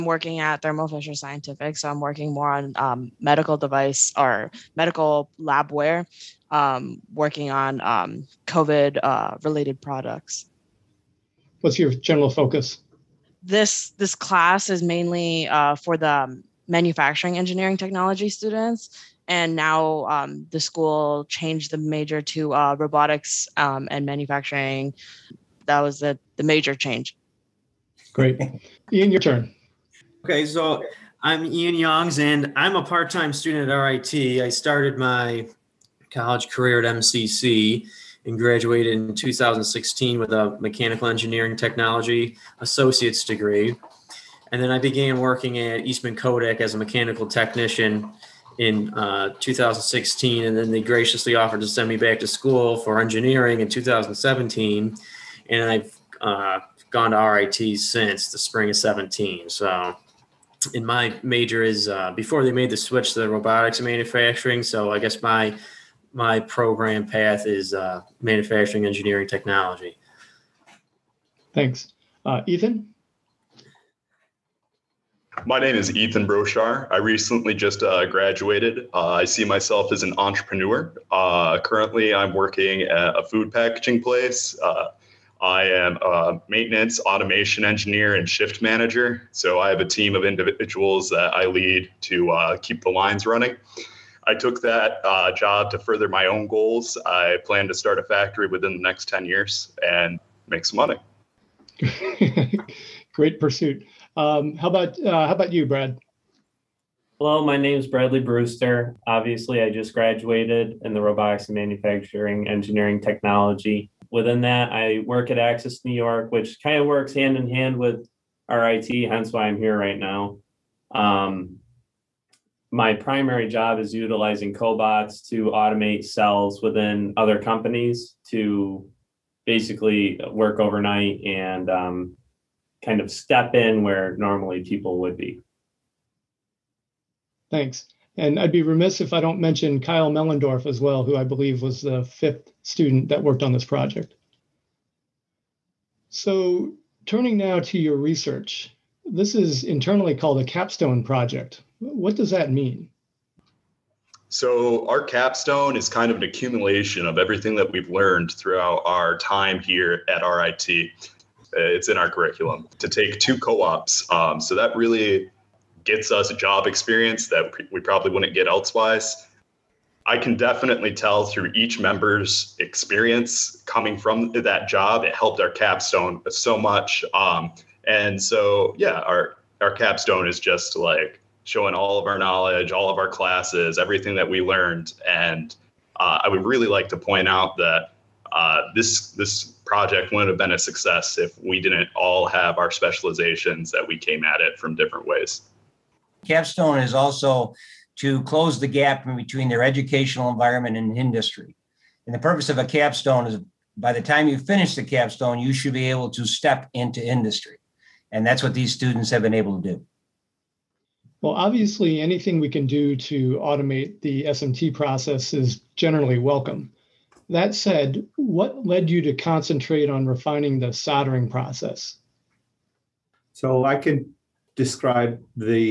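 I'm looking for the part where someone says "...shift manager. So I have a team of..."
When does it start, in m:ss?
1:28.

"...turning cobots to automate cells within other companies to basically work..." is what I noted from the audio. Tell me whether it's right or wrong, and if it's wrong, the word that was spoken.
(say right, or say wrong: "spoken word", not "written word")
wrong: "utilizing", not "turning".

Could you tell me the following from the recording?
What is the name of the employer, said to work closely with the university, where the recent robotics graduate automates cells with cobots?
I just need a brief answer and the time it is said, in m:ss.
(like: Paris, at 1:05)
Access New York, at 1:55.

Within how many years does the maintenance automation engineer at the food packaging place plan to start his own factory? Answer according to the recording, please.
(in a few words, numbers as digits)
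10.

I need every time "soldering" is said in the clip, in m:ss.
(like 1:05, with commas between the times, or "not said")
3:40.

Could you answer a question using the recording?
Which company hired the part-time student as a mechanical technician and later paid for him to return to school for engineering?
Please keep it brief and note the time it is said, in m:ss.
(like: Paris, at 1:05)
Eastman Kodak, at 0:45.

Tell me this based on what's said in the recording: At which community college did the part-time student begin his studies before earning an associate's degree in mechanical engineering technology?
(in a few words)
MCC.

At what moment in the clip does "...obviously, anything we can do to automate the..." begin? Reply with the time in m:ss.
3:31.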